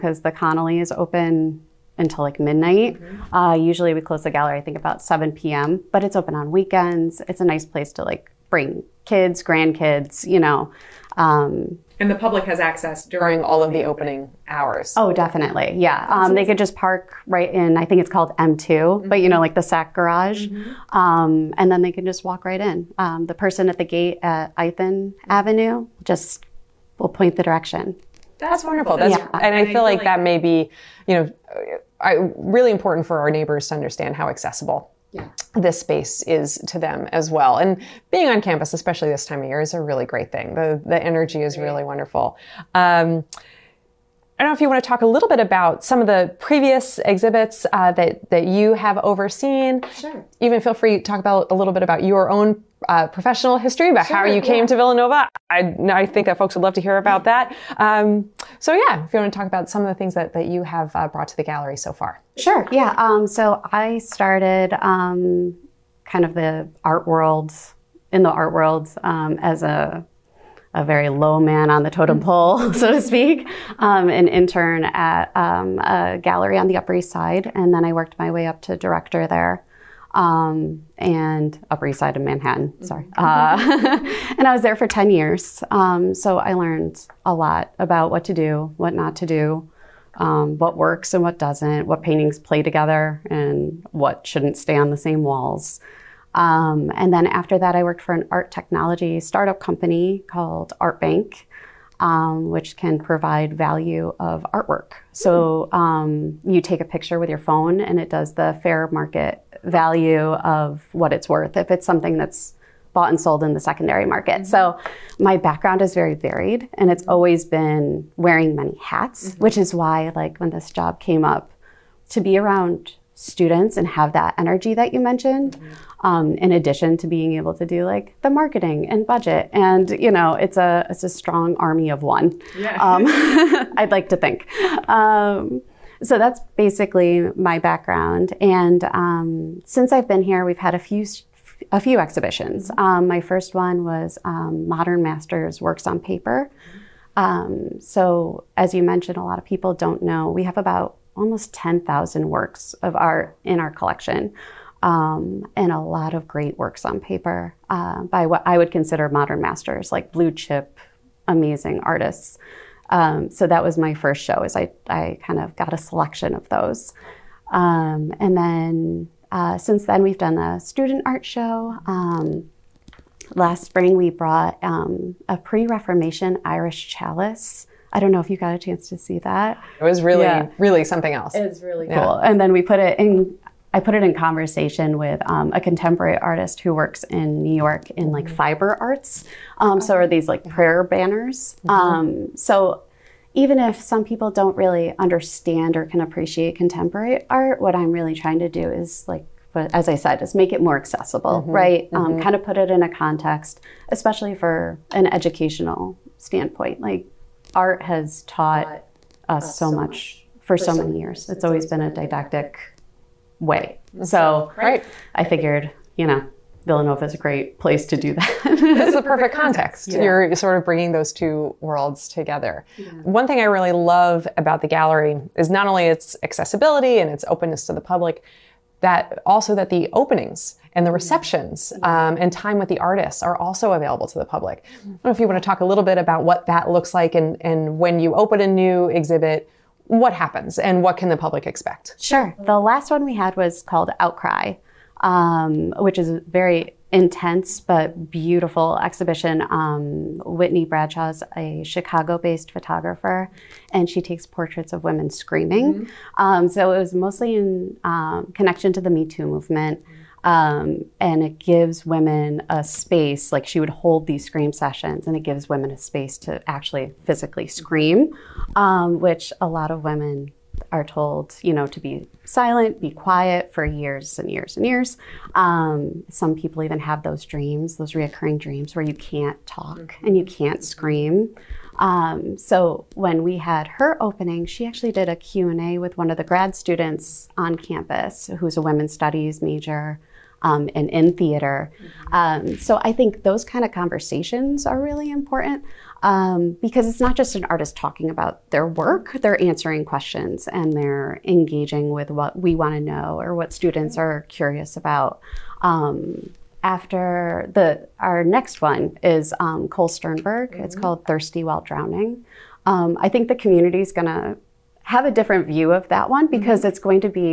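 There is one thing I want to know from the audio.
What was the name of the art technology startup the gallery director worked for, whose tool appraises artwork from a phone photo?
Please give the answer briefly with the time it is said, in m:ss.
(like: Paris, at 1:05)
Art Bank, at 1:40.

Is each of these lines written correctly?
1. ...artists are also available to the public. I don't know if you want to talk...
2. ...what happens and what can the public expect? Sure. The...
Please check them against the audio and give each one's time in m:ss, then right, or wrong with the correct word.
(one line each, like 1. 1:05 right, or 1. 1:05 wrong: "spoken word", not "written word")
1. 3:52 right
2. 3:59 right.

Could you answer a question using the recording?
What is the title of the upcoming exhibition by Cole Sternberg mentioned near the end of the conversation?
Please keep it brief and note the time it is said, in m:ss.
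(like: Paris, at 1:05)
Thirsty While Drowning, at 5:11.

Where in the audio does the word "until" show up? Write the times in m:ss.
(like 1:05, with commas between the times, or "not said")
0:01.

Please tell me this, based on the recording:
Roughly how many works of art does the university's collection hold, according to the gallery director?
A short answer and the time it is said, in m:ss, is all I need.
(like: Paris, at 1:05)
10,000, at 2:31.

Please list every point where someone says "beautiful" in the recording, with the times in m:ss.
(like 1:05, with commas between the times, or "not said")
4:08.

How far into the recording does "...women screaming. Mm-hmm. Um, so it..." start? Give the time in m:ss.
4:14.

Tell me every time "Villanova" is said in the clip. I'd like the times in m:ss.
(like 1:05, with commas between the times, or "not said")
0:54, 3:36.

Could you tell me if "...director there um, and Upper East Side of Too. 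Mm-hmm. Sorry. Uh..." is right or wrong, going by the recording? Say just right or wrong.
wrong.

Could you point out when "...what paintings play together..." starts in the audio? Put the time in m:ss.
1:31.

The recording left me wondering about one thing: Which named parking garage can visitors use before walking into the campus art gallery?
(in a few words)
M2.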